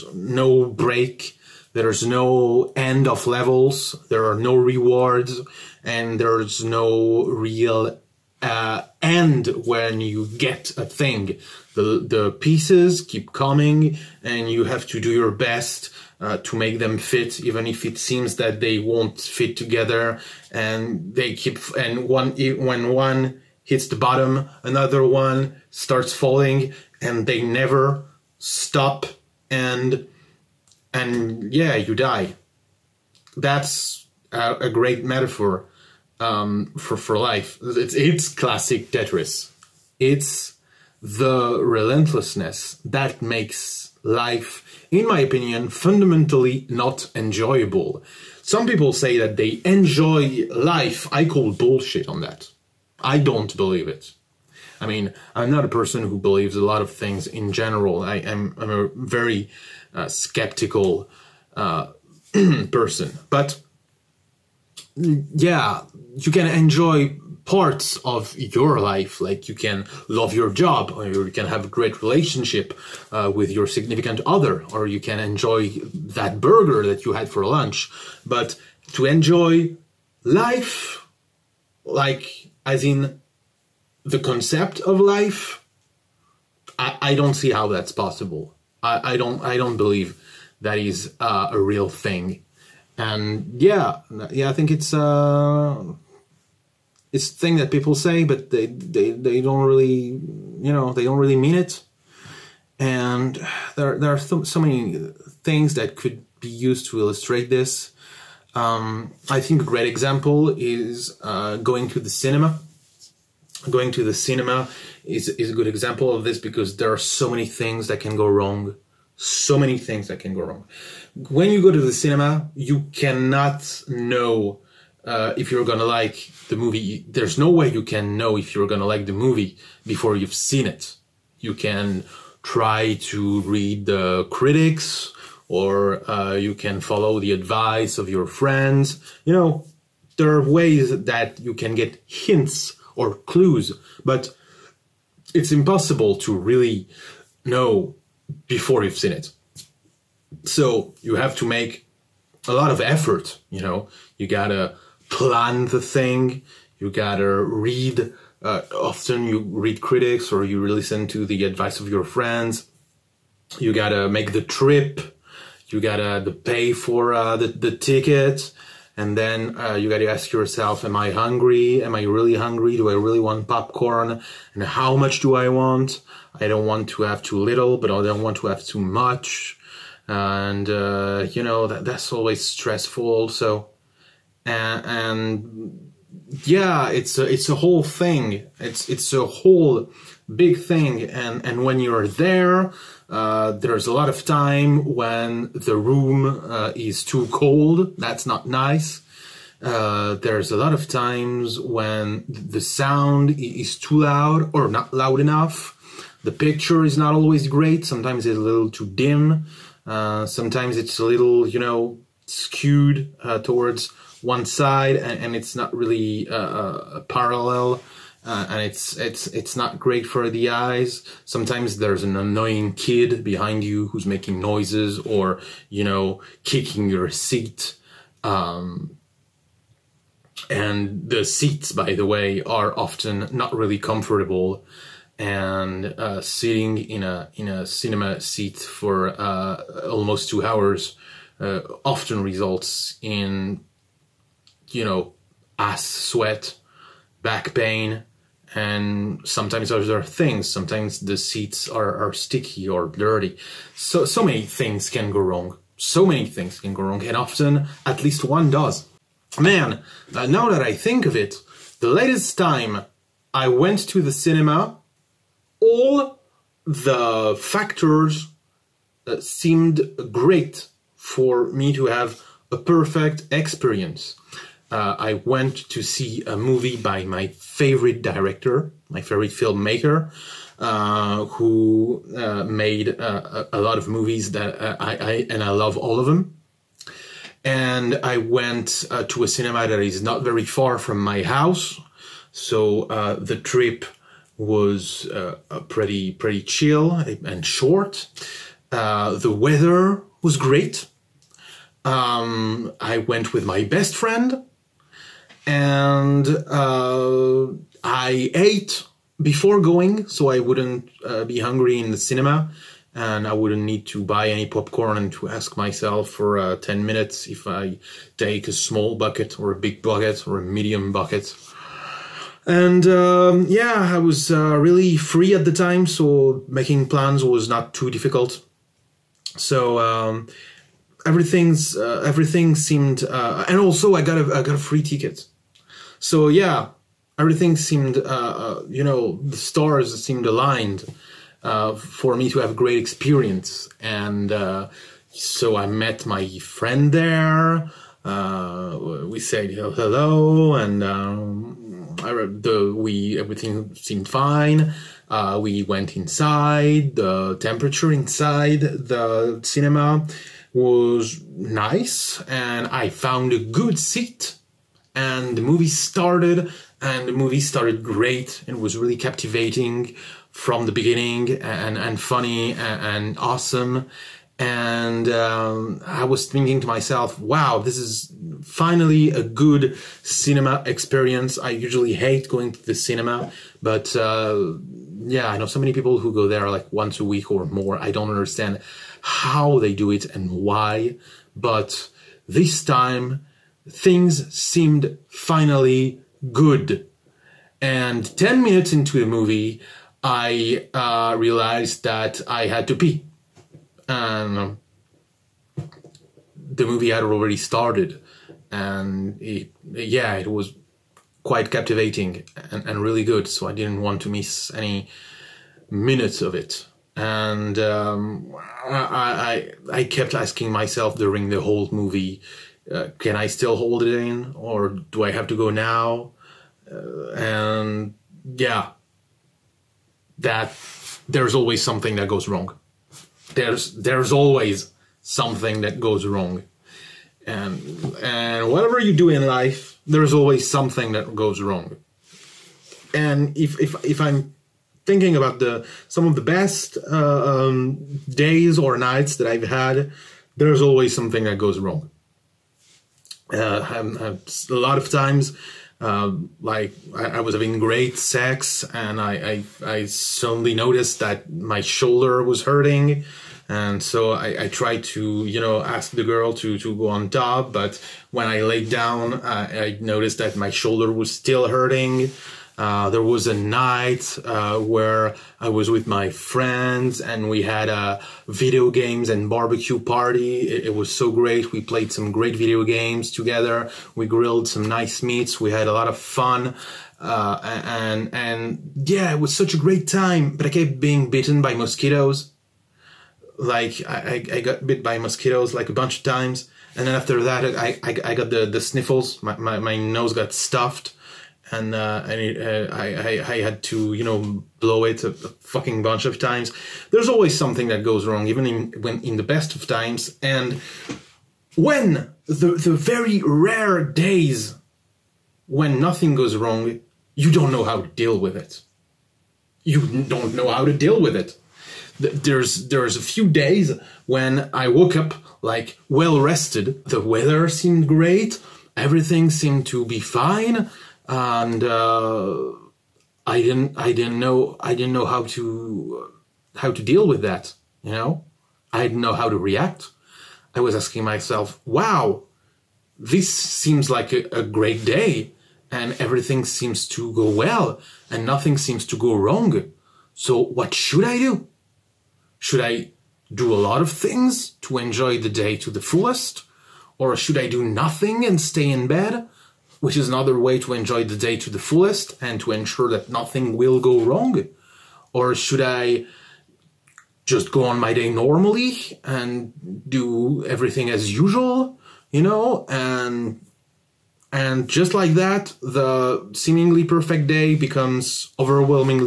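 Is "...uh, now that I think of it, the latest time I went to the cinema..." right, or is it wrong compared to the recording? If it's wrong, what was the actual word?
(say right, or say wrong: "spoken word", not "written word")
right.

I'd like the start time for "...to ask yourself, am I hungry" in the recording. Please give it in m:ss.
2:49.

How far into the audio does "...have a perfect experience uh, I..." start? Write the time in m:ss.
4:31.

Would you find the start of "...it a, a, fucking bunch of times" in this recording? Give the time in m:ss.
8:24.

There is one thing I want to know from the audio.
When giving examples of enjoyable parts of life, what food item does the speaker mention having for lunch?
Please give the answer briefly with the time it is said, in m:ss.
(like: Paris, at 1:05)
burger, at 1:16.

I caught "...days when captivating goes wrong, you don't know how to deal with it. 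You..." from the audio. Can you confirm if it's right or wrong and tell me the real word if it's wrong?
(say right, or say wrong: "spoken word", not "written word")
wrong: "nothing", not "captivating".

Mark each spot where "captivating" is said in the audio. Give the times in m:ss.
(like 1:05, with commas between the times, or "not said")
6:08, 6:51.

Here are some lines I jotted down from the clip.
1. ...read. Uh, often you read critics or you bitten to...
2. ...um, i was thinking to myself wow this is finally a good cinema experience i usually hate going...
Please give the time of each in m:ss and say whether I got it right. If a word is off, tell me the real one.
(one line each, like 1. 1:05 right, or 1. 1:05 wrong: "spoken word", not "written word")
1. 2:37 wrong: "listen", not "bitten"
2. 6:15 right.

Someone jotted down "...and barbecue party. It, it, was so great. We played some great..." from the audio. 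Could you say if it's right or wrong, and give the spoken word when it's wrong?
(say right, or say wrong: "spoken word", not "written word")
right.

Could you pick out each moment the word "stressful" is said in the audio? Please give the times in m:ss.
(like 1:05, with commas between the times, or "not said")
3:02.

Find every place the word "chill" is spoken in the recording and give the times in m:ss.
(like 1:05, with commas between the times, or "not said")
4:56.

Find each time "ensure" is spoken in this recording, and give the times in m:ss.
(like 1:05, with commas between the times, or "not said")
9:22.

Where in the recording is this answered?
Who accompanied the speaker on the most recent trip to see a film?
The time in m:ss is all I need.
5:03.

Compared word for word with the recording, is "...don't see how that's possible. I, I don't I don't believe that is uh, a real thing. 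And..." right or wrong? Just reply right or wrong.
right.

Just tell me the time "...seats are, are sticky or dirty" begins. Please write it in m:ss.
4:11.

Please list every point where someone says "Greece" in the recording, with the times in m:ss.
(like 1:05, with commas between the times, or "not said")
not said.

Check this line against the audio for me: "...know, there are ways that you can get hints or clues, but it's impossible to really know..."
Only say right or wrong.
right.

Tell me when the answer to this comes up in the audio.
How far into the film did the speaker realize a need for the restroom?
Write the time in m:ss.
6:38.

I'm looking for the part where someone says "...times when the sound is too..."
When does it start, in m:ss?
3:20.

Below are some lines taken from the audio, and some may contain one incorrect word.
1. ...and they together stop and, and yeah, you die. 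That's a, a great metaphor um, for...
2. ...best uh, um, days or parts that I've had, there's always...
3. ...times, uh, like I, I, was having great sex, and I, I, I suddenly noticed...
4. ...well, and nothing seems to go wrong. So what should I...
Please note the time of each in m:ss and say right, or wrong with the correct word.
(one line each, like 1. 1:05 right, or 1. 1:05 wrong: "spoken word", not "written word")
1. 0:27 wrong: "never", not "together"
2. 7:26 wrong: "nights", not "parts"
3. 7:34 right
4. 9:07 right.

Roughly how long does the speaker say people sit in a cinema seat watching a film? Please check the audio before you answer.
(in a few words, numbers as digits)
almost 2 hours.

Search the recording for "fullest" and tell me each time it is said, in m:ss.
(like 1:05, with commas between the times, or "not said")
9:15, 9:21.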